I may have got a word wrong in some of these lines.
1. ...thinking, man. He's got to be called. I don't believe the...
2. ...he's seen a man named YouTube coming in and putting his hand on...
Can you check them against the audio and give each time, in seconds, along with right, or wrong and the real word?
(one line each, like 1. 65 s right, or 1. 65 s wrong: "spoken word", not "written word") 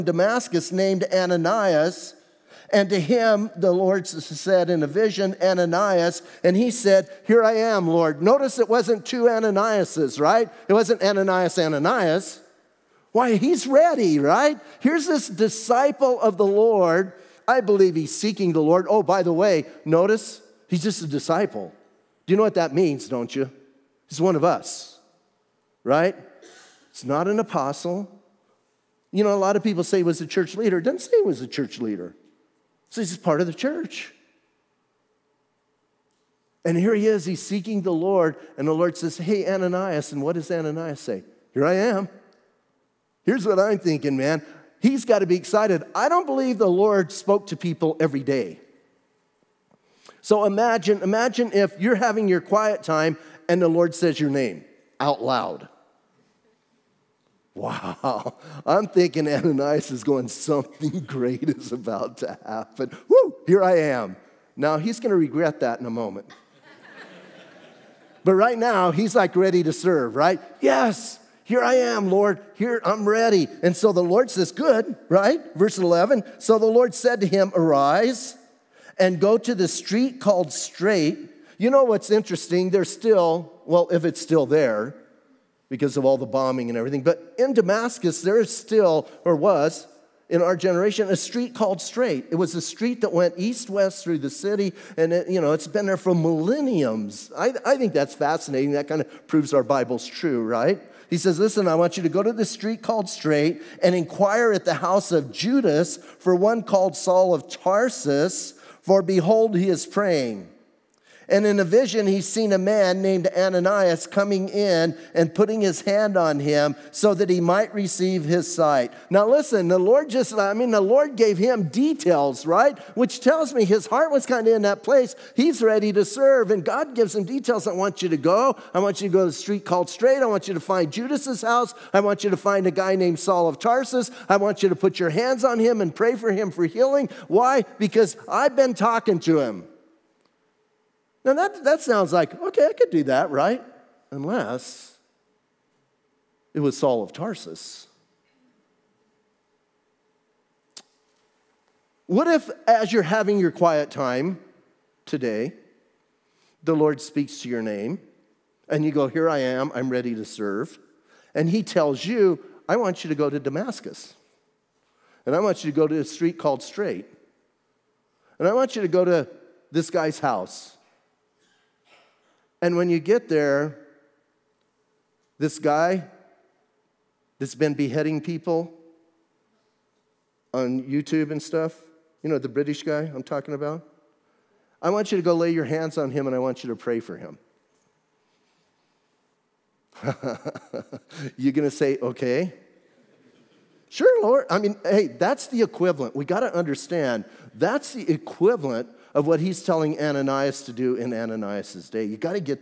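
1. 43 s wrong: "excited", not "called"
2. 112 s wrong: "Ananias", not "YouTube".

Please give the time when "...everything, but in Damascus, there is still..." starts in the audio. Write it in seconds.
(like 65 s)
86 s.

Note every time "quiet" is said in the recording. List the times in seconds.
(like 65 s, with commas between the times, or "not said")
52 s, 153 s.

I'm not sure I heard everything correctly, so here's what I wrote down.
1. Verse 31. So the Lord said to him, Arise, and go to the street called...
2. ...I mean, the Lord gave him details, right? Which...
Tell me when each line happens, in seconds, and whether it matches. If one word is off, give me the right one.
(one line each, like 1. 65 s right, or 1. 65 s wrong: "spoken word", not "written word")
1. 75 s wrong: "11", not "31"
2. 120 s right.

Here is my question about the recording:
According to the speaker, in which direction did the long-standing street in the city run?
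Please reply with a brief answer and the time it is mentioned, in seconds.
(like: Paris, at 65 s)
East west, at 93 s.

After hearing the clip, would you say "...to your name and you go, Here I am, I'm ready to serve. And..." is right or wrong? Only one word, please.
right.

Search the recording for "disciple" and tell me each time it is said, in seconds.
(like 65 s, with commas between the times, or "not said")
15 s, 21 s.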